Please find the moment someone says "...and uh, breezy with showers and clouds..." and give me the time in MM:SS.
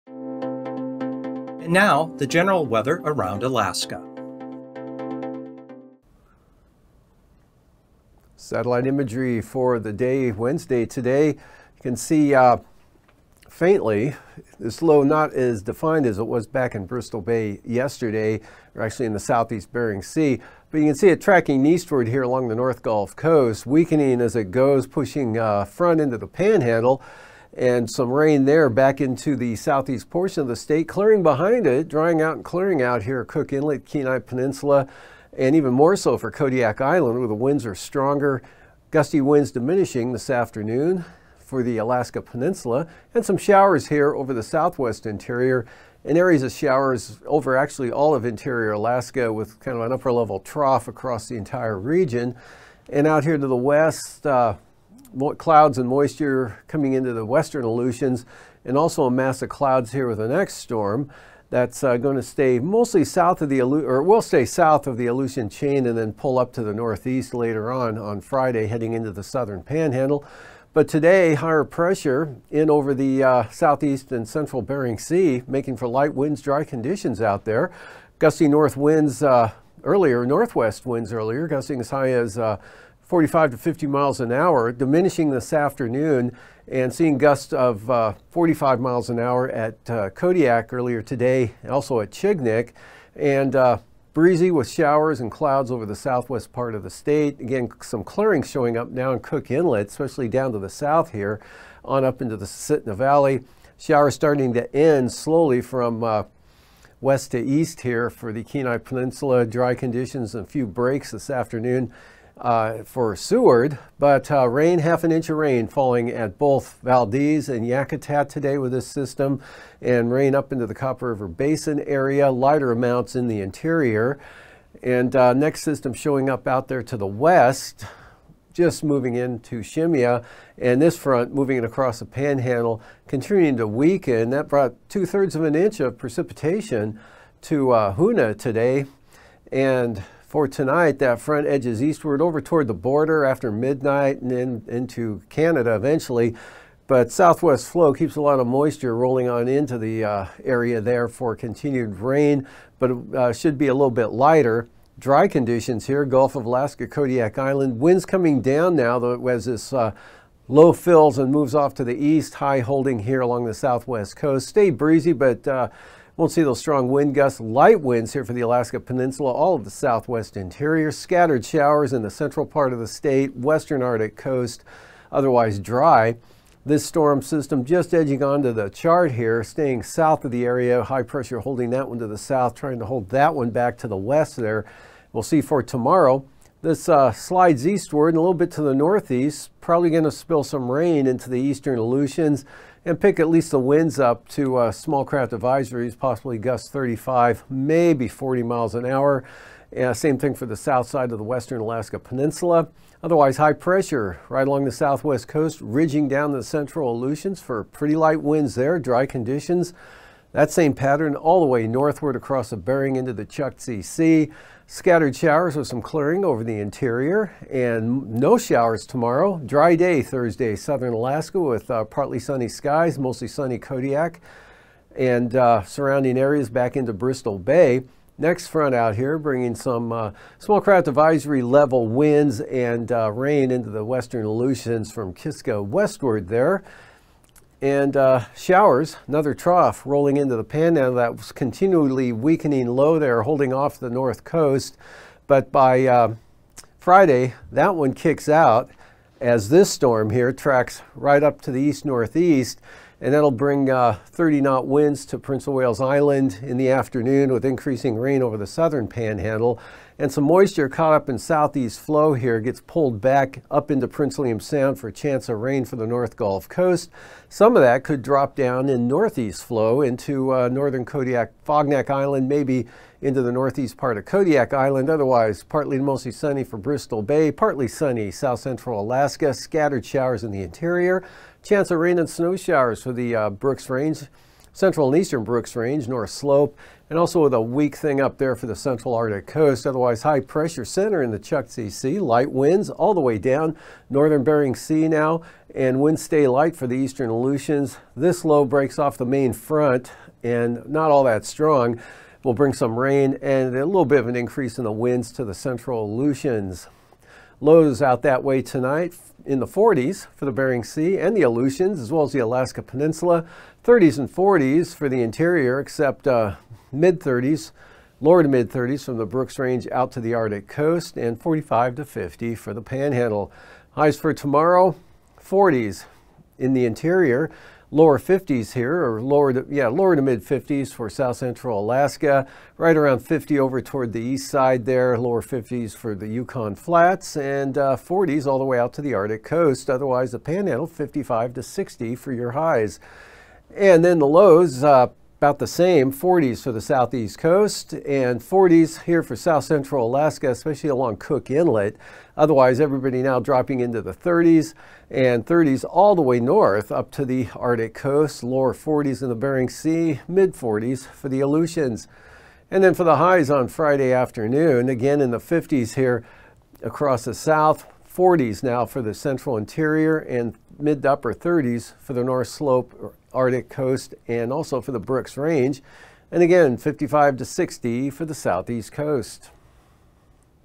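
01:33.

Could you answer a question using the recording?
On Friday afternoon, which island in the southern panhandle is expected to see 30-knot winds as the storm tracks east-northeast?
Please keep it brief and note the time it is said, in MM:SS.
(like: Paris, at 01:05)
Prince of Wales Island, at 04:15.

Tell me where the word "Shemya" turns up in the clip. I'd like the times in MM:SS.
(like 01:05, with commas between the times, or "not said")
02:09.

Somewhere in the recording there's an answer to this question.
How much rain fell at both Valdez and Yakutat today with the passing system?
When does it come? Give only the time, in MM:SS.
01:54.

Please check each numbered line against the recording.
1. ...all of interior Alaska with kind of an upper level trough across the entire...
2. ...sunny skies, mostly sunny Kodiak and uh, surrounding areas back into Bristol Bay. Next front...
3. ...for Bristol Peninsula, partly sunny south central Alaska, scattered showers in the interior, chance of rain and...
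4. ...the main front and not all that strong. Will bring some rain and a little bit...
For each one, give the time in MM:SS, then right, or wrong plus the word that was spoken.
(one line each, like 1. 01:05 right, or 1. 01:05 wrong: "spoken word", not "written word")
1. 00:47 right
2. 03:42 right
3. 04:36 wrong: "Bay", not "Peninsula"
4. 04:58 right.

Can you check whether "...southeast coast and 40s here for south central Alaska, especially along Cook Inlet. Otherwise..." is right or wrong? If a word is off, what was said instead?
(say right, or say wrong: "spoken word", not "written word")
right.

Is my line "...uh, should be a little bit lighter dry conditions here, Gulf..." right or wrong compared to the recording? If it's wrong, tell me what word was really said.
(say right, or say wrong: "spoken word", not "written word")
right.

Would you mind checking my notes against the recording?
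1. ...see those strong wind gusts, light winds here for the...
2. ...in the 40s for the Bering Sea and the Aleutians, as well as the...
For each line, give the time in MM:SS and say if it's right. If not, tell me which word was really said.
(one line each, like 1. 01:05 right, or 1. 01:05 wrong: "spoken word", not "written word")
1. 02:46 right
2. 05:09 right.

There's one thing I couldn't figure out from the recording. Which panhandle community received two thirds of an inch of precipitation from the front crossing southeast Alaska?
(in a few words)
Hoonah.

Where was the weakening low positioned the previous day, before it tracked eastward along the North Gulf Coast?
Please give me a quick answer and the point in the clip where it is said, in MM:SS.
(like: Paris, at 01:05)
Southeast Bering Sea, at 00:19.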